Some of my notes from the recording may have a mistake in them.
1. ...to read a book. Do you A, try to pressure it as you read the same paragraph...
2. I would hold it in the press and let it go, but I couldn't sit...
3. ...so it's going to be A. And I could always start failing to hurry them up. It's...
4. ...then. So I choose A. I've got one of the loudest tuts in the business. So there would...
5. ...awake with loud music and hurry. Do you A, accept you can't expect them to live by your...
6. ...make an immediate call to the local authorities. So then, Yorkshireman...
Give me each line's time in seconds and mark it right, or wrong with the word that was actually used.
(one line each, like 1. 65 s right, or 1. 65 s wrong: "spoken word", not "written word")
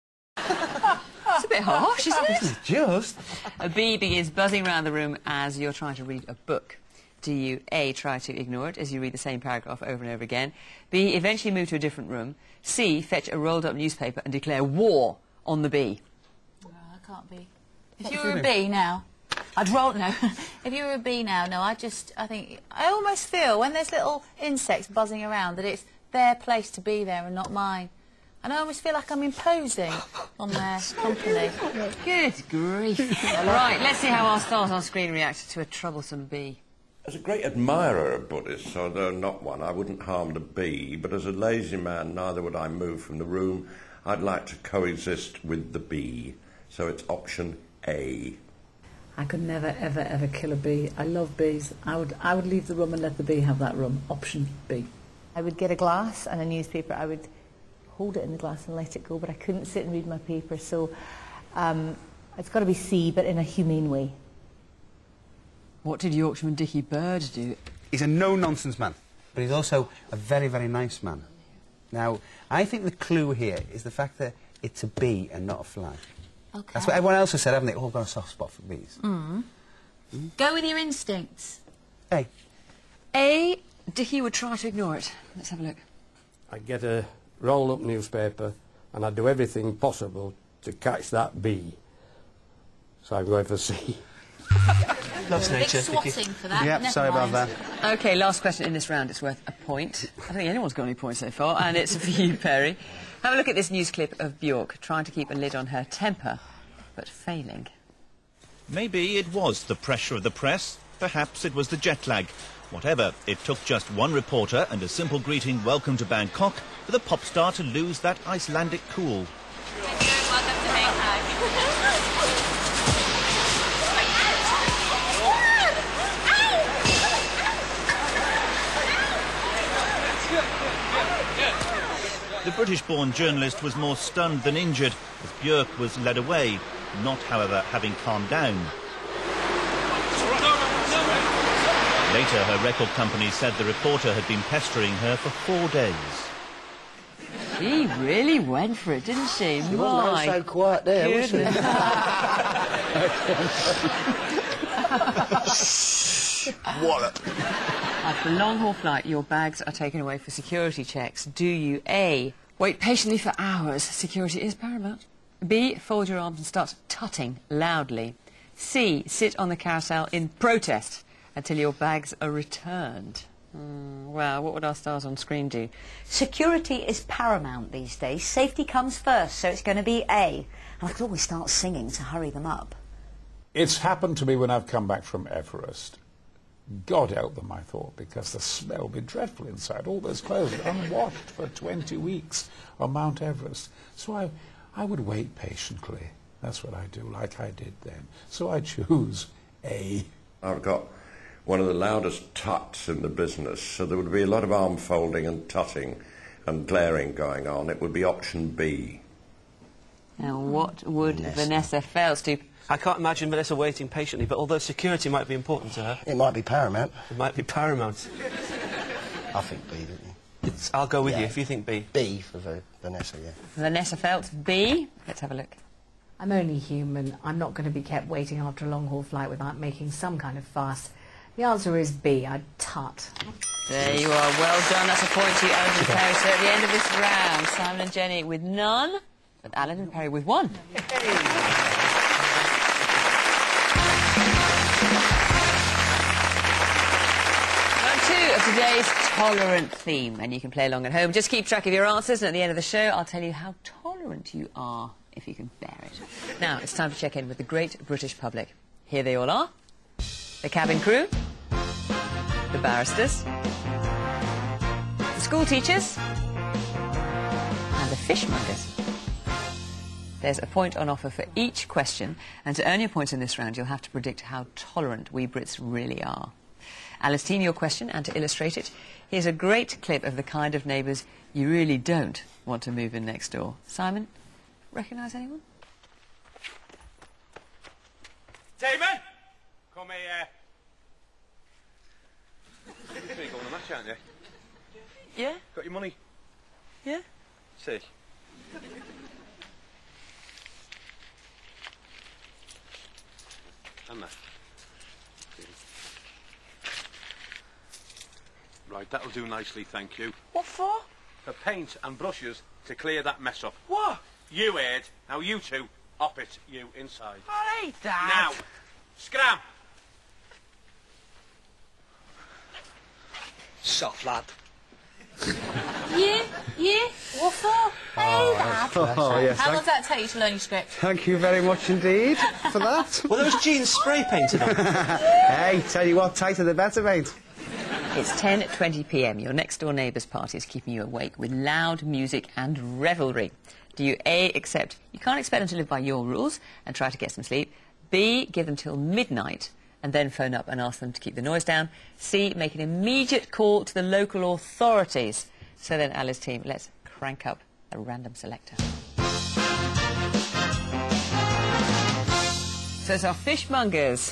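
1. 5 s wrong: "ignore", not "pressure"
2. 56 s wrong: "glass", not "press"
3. 179 s wrong: "singing", not "failing"
4. 197 s right
5. 340 s wrong: "revelry", not "hurry"
6. 352 s wrong: "Alice", not "Yorkshireman".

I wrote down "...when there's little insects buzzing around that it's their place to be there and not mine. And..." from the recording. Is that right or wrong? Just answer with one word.
right.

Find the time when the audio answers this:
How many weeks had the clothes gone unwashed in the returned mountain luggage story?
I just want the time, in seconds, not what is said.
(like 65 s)
191 s.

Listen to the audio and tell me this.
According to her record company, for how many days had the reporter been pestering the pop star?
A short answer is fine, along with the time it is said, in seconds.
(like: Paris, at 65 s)
4, at 145 s.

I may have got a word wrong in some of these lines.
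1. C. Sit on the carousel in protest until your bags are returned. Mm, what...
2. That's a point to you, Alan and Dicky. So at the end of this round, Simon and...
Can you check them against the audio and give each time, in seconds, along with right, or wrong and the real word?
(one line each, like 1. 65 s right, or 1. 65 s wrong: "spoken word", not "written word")
1. 168 s right
2. 234 s wrong: "Perry", not "Dicky".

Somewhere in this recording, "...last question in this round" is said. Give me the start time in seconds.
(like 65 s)
98 s.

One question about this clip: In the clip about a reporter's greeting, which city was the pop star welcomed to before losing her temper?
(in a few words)
Bangkok.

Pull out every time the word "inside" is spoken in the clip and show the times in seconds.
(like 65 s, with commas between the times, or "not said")
189 s, 316 s.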